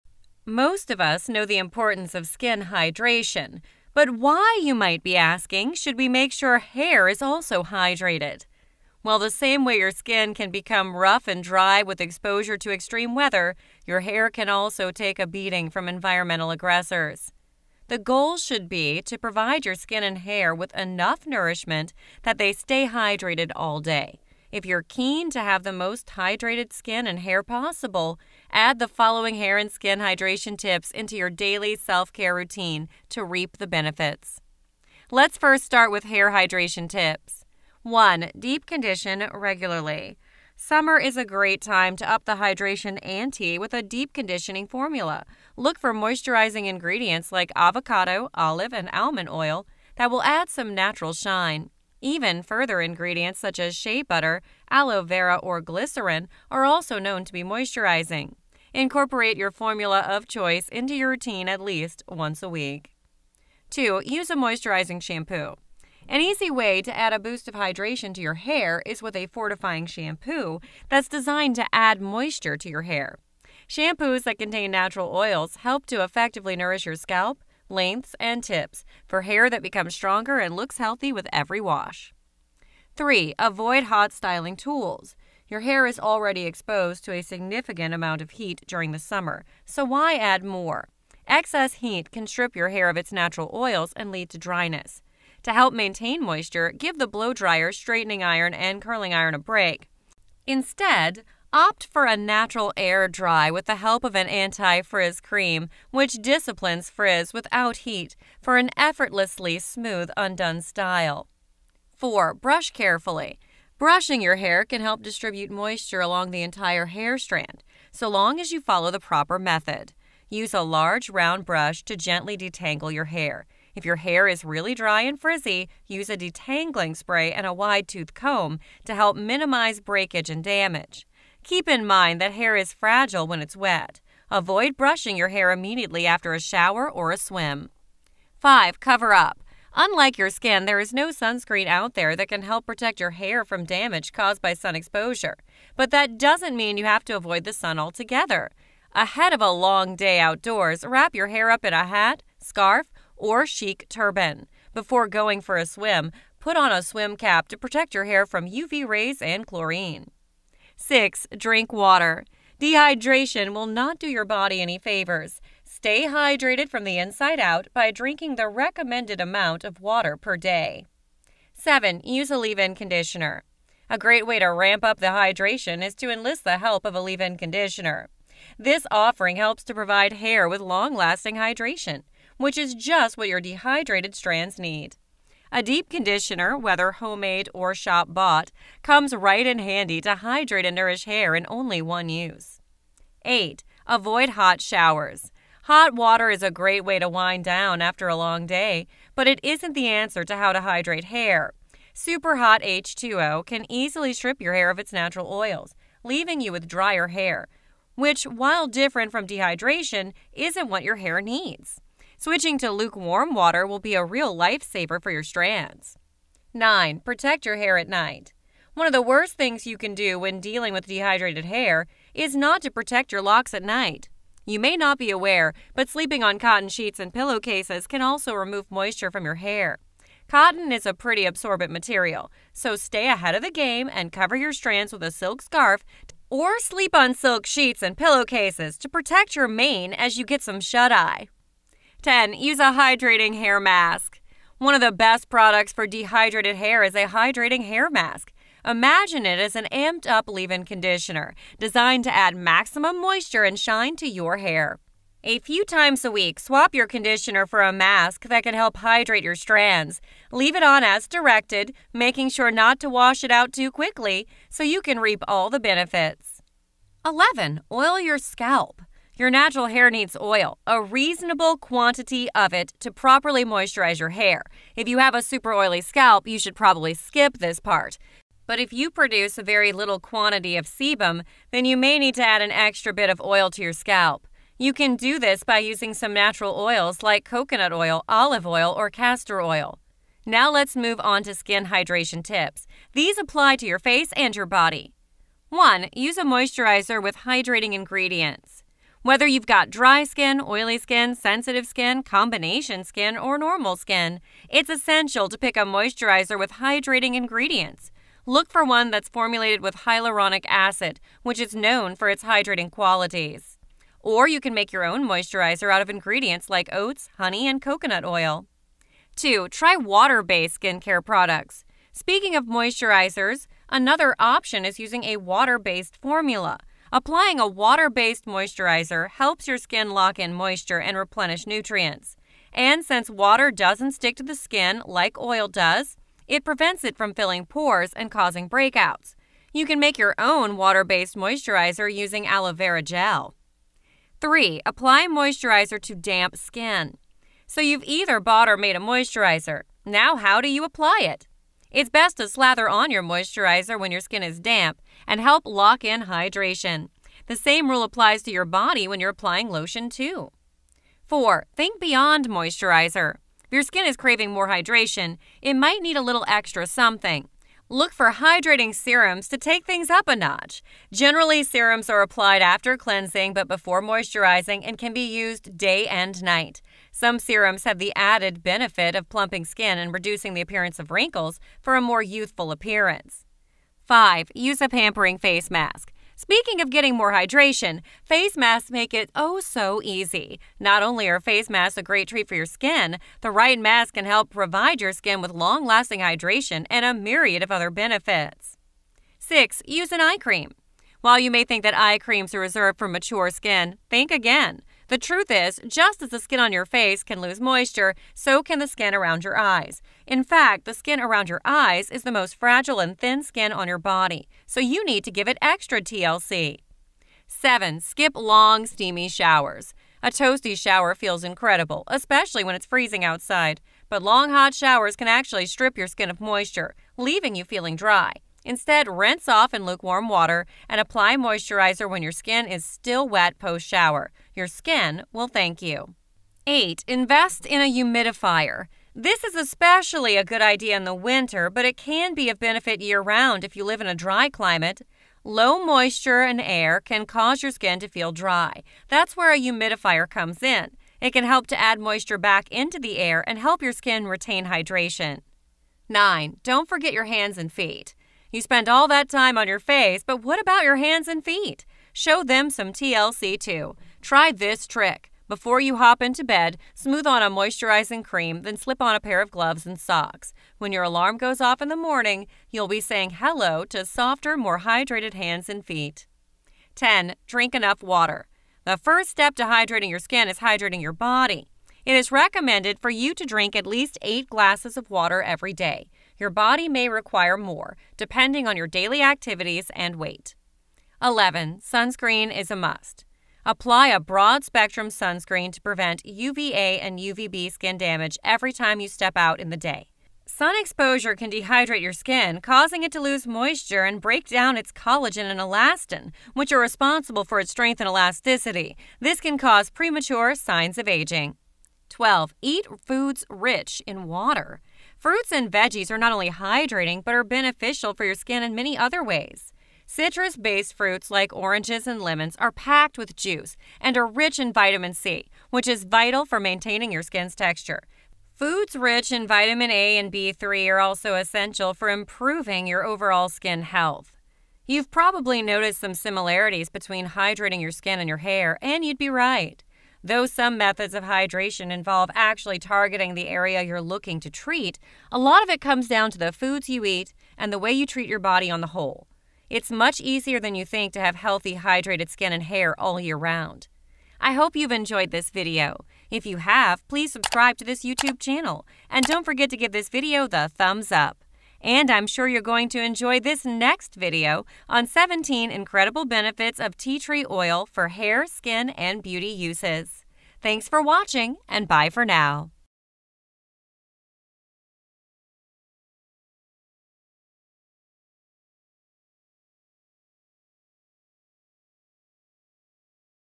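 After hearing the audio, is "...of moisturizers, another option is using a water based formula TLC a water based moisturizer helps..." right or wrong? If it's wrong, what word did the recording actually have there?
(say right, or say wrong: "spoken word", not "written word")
wrong: "Applying", not "TLC".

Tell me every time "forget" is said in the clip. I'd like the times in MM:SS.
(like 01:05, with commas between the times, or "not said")
07:36, 09:19.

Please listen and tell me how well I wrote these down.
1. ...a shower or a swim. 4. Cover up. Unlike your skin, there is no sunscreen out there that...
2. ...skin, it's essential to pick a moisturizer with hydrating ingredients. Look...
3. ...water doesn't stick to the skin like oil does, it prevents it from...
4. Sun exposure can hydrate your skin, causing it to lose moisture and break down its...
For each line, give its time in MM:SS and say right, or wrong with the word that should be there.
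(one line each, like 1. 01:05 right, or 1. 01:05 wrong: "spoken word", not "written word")
1. 02:16 wrong: "5", not "4"
2. 05:03 right
3. 05:33 right
4. 08:20 wrong: "dehydrate", not "hydrate".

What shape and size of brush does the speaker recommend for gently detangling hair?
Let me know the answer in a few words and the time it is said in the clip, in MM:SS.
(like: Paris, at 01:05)
large round brush, at 02:00.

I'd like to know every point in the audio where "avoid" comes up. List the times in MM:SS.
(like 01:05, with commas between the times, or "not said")
01:23, 02:14, 02:27, 03:13.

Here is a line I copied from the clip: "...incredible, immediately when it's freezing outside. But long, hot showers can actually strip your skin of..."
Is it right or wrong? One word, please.
wrong.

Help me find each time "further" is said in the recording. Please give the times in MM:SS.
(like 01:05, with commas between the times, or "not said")
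00:52.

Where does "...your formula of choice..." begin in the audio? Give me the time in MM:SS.
00:59.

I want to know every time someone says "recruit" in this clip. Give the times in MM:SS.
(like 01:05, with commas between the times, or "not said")
not said.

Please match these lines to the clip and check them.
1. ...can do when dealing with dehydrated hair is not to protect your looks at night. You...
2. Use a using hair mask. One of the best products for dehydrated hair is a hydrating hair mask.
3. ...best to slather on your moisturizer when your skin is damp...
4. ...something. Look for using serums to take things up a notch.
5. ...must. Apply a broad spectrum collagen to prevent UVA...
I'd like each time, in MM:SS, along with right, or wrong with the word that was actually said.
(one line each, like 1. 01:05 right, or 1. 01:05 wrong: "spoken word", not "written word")
1. 03:39 wrong: "locks", not "looks"
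2. 04:02 wrong: "hydrating", not "using"
3. 05:51 right
4. 06:06 wrong: "hydrating", not "using"
5. 08:12 wrong: "sunscreen", not "collagen".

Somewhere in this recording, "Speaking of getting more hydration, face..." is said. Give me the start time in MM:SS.
06:26.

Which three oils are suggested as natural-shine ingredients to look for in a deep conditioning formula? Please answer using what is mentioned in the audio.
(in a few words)
avocado, olive, and almond oil.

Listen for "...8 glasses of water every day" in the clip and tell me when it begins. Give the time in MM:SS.
08:04.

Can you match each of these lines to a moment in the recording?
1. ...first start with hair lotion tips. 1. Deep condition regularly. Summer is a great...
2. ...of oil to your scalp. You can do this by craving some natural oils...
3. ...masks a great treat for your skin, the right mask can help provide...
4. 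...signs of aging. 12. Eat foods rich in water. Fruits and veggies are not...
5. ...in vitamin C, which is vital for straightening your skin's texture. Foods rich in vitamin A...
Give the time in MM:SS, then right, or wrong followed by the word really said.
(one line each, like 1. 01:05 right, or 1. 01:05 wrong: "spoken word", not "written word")
1. 00:35 wrong: "hydration", not "lotion"
2. 04:43 wrong: "using", not "craving"
3. 06:31 right
4. 08:30 right
5. 08:44 wrong: "maintaining", not "straightening".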